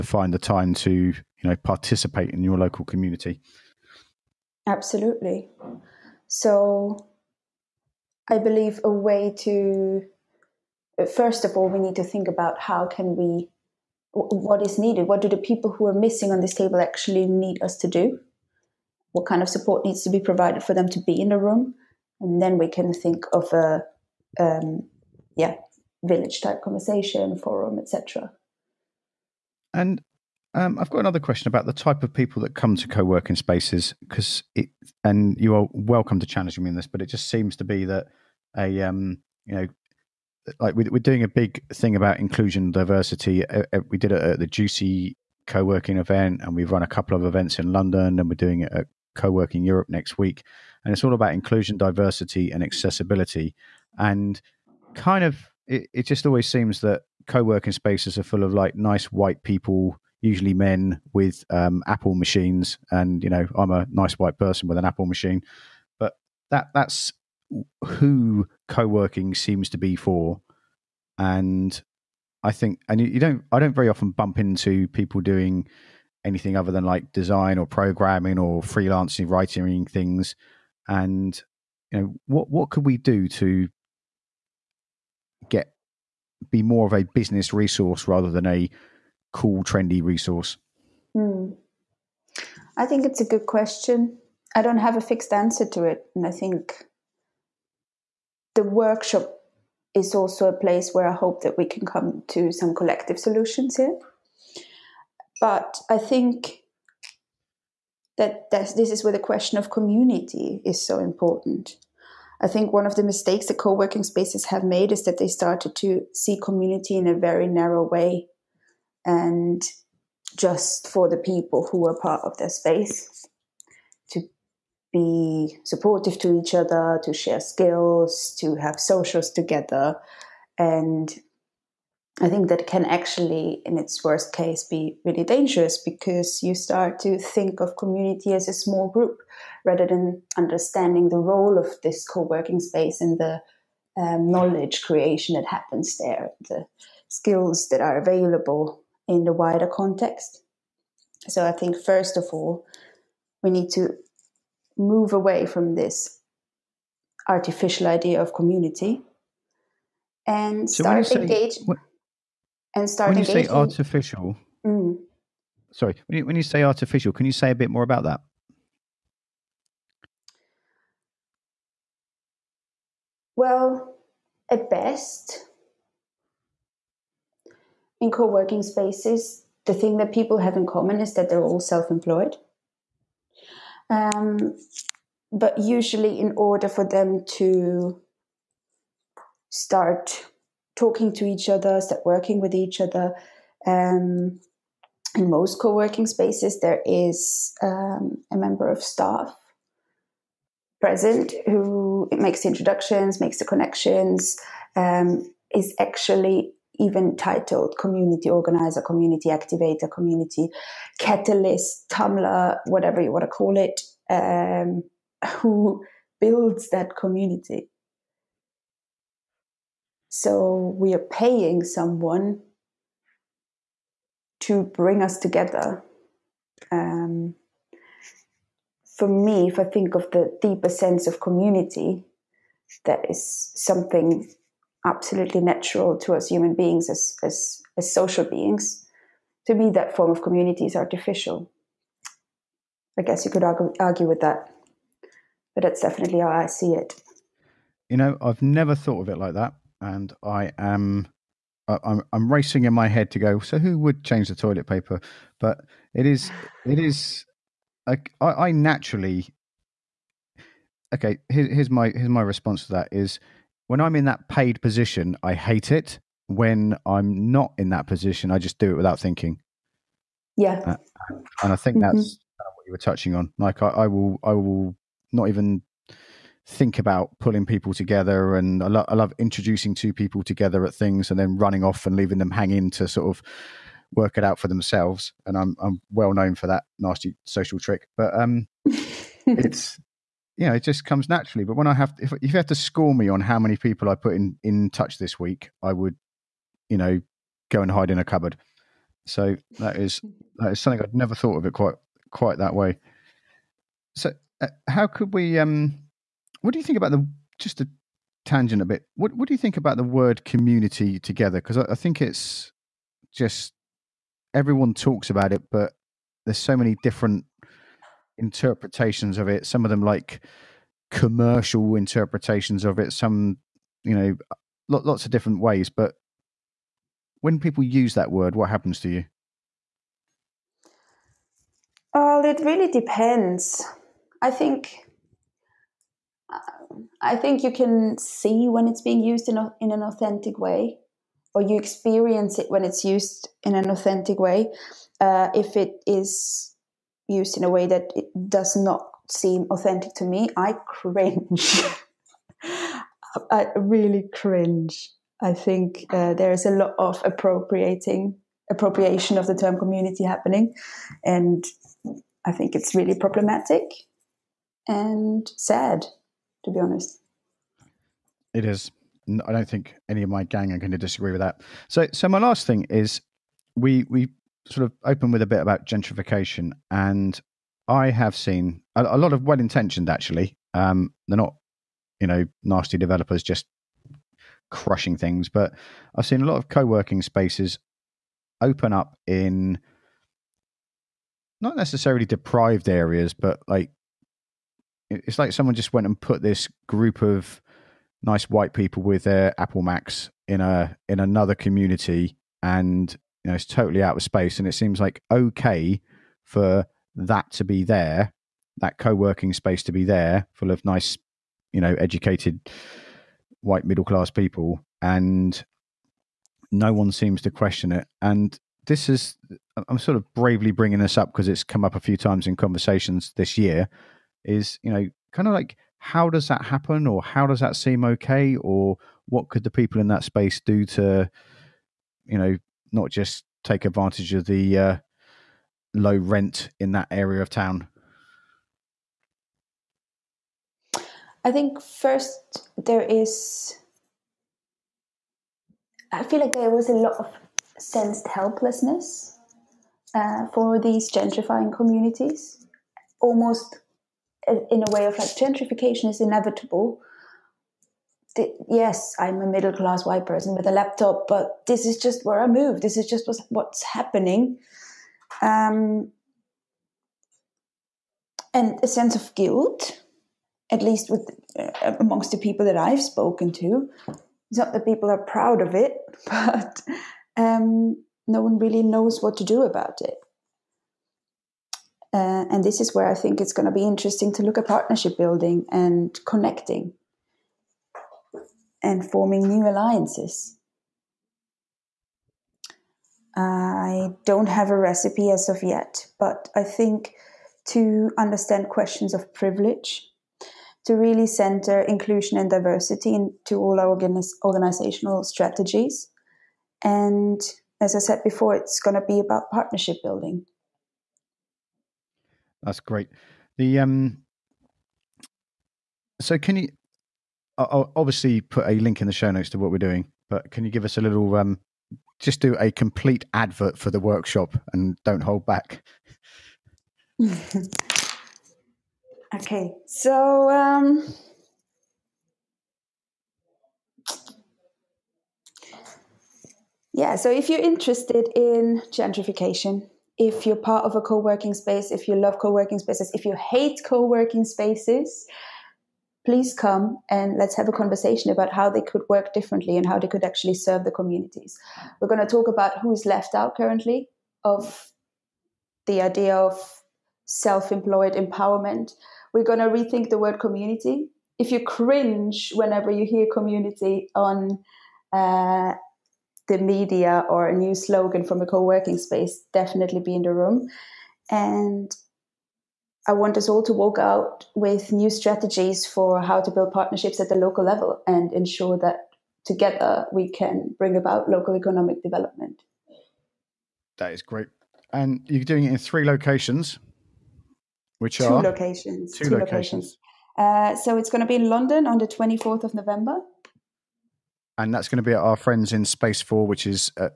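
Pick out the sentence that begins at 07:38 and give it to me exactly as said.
The, yes, I'm a middle class white person with a laptop, but this is just where I move.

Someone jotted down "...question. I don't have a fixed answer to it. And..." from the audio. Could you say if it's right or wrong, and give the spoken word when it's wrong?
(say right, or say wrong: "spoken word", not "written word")
right.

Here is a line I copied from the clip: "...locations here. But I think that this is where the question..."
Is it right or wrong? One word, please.
wrong.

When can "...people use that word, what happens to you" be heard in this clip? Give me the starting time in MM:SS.
05:27.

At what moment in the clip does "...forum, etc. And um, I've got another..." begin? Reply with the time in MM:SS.
00:27.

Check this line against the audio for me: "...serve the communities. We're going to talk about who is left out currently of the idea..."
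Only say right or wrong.
right.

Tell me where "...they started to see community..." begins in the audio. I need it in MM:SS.
01:55.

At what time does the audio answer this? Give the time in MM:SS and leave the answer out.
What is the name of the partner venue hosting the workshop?
09:55.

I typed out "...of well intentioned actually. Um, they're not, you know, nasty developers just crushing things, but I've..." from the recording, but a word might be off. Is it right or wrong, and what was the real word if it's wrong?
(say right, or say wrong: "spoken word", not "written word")
right.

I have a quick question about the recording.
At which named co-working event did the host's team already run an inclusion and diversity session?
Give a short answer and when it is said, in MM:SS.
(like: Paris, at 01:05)
Juicy co-working event, at 00:44.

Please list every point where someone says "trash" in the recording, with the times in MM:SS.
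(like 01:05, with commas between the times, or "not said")
not said.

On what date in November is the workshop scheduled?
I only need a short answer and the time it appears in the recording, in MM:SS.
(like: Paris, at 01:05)
24 November, at 09:51.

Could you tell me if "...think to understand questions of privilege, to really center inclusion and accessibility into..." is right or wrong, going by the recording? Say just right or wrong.
wrong.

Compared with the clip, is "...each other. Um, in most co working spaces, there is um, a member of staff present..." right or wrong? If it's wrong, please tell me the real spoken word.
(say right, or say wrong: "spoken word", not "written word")
right.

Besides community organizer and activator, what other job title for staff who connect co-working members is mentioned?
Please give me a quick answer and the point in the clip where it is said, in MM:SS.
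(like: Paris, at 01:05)
community catalyst, at 03:29.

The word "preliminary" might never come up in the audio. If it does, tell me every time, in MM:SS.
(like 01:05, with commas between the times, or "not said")
not said.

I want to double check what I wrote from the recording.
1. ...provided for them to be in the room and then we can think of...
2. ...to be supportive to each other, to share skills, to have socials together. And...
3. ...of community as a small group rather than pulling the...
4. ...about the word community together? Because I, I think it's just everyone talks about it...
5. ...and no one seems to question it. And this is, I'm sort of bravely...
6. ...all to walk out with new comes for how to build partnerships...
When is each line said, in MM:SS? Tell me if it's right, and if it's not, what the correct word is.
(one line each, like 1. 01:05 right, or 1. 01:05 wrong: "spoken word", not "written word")
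1. 00:20 right
2. 02:04 right
3. 02:17 wrong: "understanding", not "pulling"
4. 05:09 right
5. 06:54 right
6. 09:33 wrong: "strategies", not "comes".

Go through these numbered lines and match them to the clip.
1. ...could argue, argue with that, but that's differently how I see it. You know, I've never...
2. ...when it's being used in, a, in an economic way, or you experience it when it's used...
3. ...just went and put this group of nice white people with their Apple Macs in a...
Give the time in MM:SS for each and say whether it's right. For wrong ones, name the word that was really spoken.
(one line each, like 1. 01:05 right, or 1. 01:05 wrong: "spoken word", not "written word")
1. 04:03 wrong: "definitely", not "differently"
2. 05:38 wrong: "authentic", not "economic"
3. 06:35 right.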